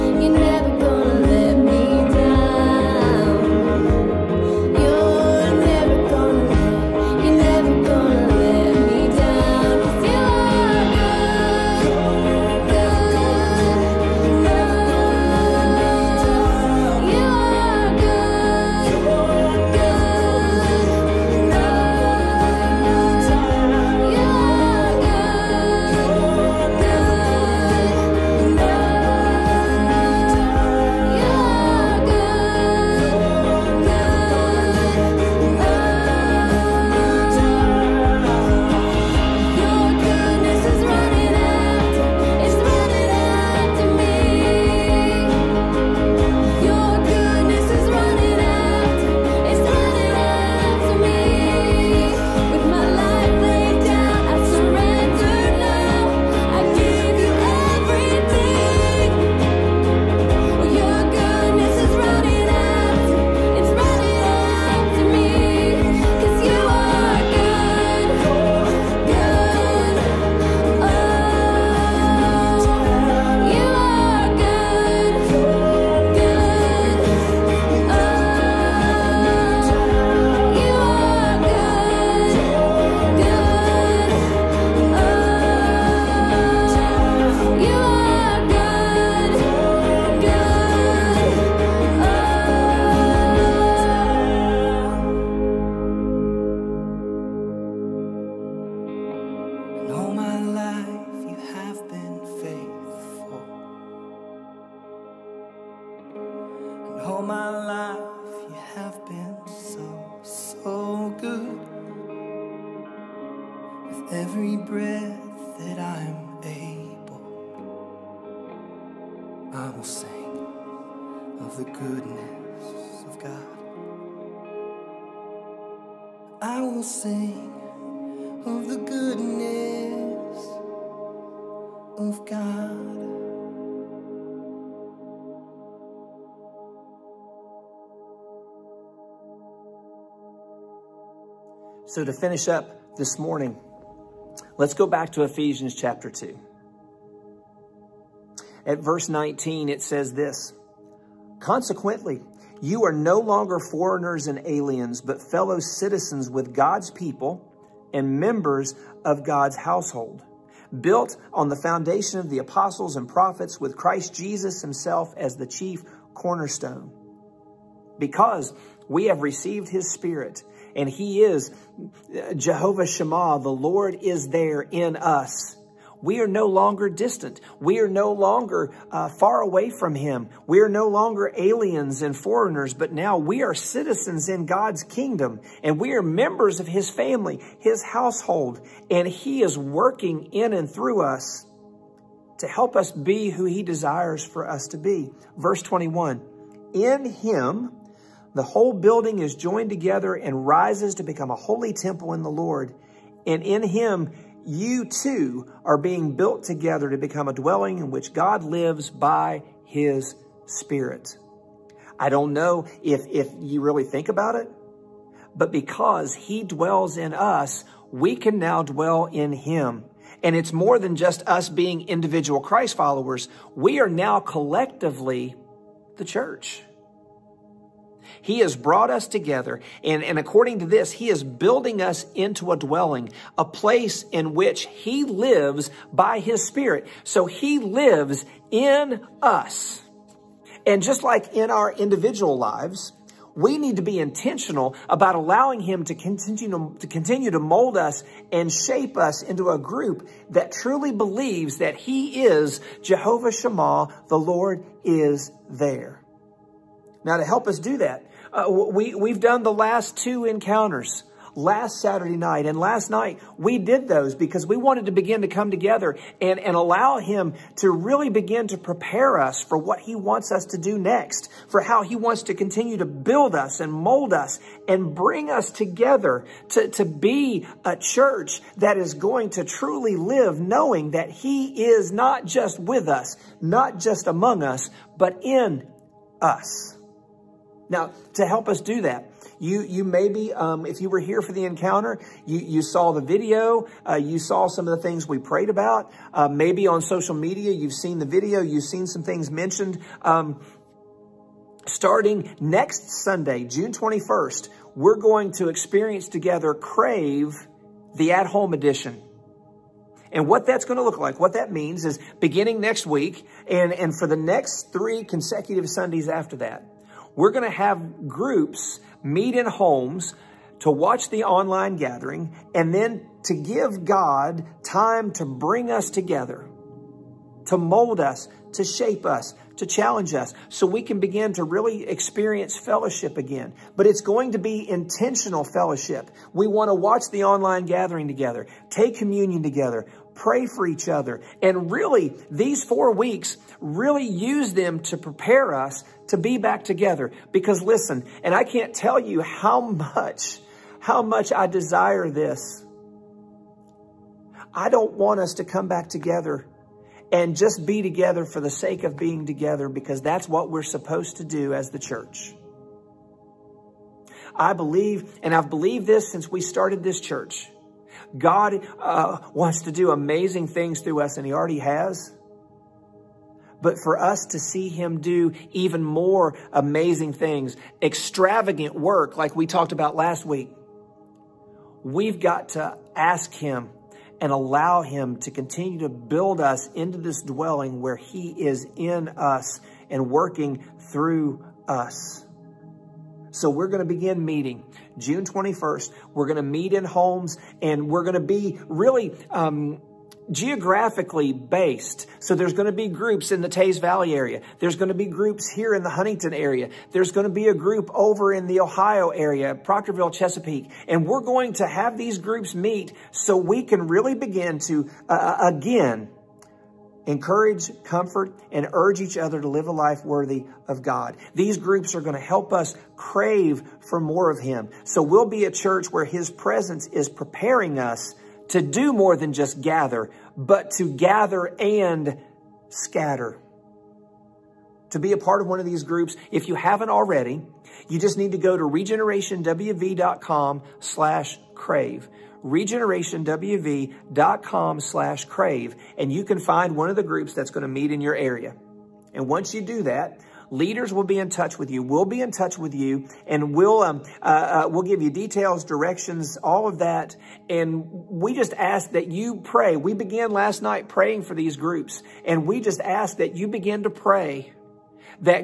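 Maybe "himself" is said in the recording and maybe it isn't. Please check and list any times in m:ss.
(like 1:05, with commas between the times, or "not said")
2:44.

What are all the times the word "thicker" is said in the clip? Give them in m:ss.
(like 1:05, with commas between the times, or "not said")
not said.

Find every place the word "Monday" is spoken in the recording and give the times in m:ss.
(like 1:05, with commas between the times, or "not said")
not said.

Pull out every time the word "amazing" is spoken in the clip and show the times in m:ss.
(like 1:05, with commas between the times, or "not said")
6:09, 6:16.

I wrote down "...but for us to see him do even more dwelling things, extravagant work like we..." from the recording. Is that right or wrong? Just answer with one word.
wrong.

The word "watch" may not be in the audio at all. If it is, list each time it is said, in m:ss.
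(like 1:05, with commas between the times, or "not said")
5:20, 5:36.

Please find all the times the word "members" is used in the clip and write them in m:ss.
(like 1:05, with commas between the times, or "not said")
2:38, 3:06.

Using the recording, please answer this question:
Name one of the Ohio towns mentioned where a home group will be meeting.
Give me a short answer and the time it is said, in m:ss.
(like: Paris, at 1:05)
Proctorville, at 6:49.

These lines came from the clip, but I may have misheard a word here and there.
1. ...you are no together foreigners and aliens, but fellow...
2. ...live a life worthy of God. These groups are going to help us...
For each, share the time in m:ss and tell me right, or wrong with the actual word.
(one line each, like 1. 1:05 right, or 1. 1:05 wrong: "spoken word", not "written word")
1. 2:32 wrong: "longer", not "together"
2. 6:59 right.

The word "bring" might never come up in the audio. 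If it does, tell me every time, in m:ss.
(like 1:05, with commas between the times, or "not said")
4:34, 5:25.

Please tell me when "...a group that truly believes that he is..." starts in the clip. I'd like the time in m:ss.
4:09.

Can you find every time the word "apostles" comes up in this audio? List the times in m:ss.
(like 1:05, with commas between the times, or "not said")
2:42.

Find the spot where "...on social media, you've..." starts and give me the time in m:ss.
4:56.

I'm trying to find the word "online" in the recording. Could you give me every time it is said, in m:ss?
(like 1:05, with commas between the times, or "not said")
5:21, 5:37.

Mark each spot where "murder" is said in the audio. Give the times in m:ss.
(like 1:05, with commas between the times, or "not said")
not said.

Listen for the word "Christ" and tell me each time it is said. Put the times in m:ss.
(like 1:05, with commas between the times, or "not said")
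2:43, 3:42.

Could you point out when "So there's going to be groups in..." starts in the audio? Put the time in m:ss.
6:42.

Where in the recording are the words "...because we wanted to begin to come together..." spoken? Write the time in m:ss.
4:24.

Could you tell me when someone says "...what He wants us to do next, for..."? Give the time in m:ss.
4:29.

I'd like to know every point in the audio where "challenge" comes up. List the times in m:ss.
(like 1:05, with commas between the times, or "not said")
5:29.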